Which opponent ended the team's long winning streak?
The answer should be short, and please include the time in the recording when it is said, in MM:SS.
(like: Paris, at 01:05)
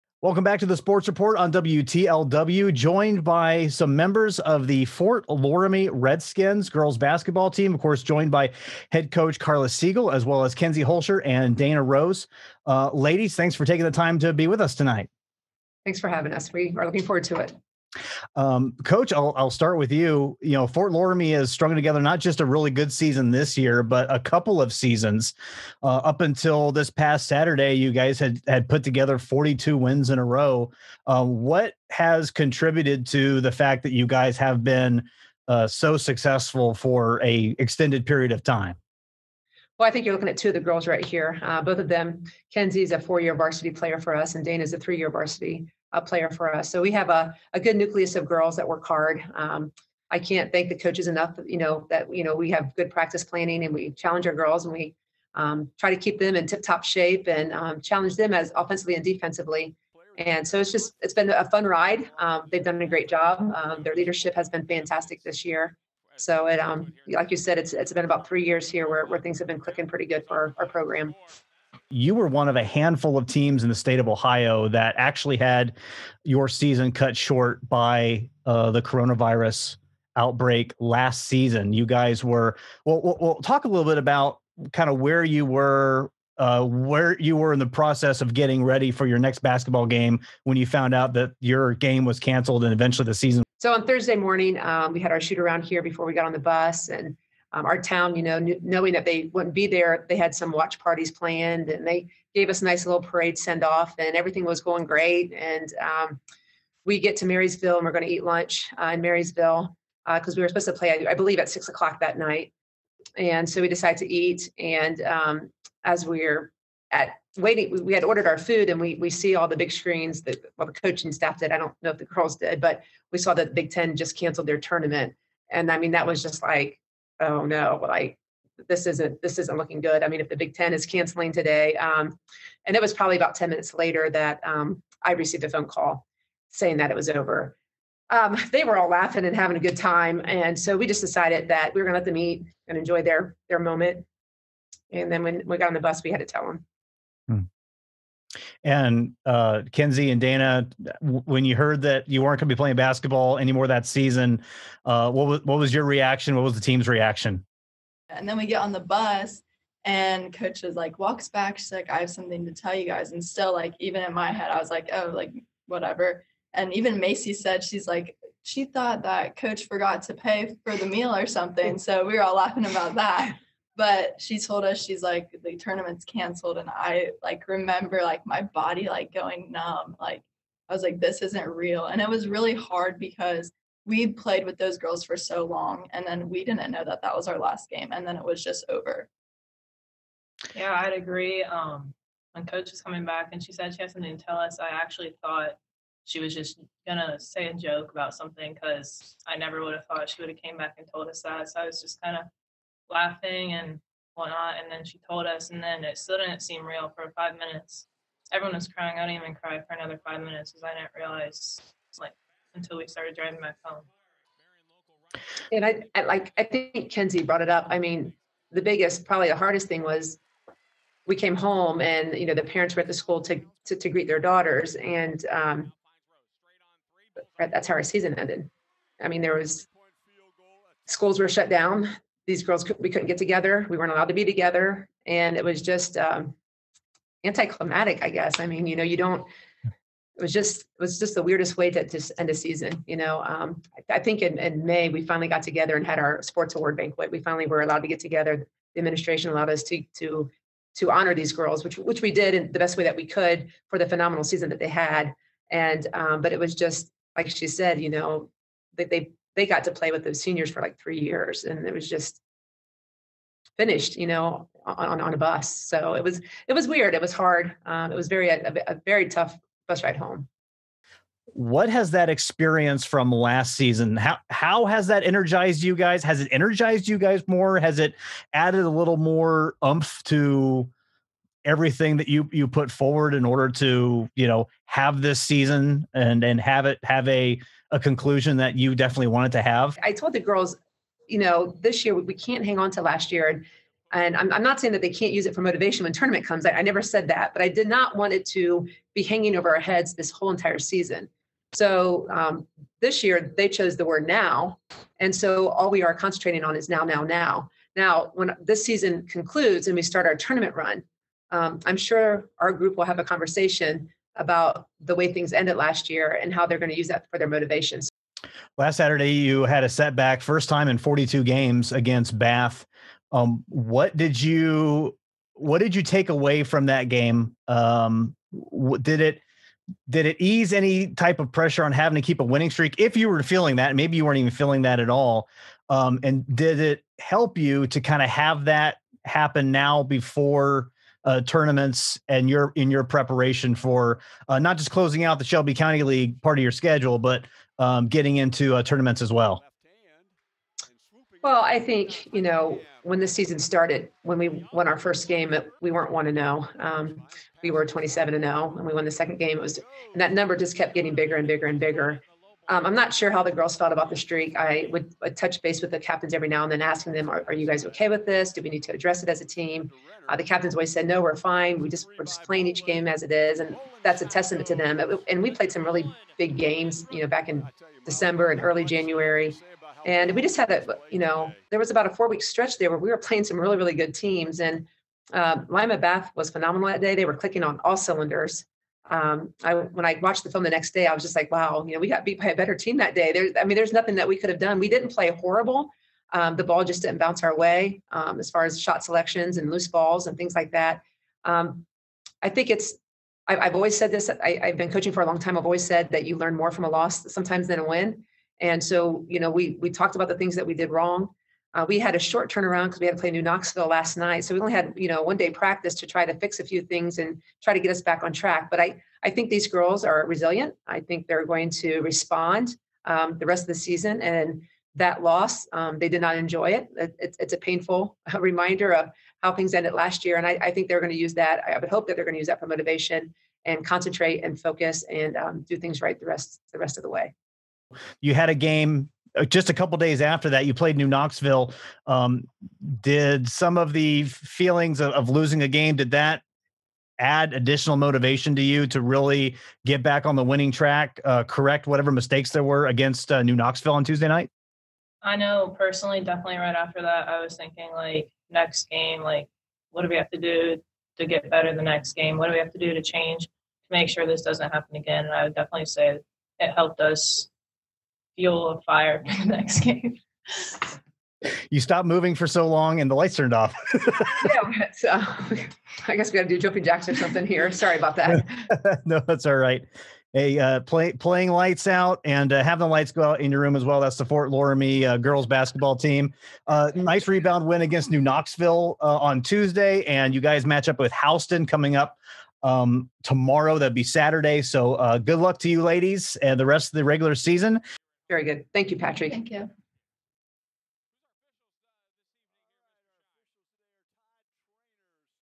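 Lima Bath, at 06:25.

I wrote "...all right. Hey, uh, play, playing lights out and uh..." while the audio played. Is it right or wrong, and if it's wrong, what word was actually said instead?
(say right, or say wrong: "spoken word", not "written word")
right.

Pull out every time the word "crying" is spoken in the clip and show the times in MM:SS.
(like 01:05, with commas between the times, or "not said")
03:28.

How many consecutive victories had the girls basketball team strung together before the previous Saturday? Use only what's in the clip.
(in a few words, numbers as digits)
42.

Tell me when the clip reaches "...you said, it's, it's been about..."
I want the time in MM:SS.
01:07.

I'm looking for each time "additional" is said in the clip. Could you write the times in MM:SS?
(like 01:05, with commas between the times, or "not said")
07:27.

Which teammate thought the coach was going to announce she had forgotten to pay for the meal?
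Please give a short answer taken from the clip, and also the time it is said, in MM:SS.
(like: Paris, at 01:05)
Macy, at 02:46.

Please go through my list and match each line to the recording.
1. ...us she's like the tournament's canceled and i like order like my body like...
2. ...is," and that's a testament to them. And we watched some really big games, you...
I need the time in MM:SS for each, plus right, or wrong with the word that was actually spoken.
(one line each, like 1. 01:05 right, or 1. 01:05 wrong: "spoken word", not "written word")
1. 02:54 wrong: "remember", not "order"
2. 06:13 wrong: "played", not "watched".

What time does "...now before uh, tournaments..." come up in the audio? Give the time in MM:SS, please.
05:39.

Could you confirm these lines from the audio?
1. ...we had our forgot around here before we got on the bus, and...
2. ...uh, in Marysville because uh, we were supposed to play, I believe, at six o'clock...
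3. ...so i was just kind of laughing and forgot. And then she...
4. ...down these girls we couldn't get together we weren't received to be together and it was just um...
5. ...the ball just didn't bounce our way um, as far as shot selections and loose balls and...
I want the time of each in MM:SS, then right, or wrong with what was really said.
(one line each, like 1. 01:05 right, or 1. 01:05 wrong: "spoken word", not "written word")
1. 01:34 wrong: "shoot", not "forgot"
2. 01:48 right
3. 03:21 wrong: "whatnot", not "forgot"
4. 03:51 wrong: "allowed", not "received"
5. 06:36 right.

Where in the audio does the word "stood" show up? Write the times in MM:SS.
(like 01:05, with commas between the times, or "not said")
not said.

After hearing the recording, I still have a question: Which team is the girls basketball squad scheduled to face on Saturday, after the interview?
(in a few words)
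Houston.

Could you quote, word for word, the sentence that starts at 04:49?
I told the girls, you know, this year we can't hang on to last year.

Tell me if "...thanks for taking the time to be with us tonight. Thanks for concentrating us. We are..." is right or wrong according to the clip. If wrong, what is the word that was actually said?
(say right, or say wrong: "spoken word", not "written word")
wrong: "having", not "concentrating".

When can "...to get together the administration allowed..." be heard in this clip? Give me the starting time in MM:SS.
04:07.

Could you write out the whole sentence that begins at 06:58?
But I I think these girls are resilient.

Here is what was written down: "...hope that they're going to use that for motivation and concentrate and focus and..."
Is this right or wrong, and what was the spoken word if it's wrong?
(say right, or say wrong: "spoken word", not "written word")
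right.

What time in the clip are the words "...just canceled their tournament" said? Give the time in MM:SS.
02:03.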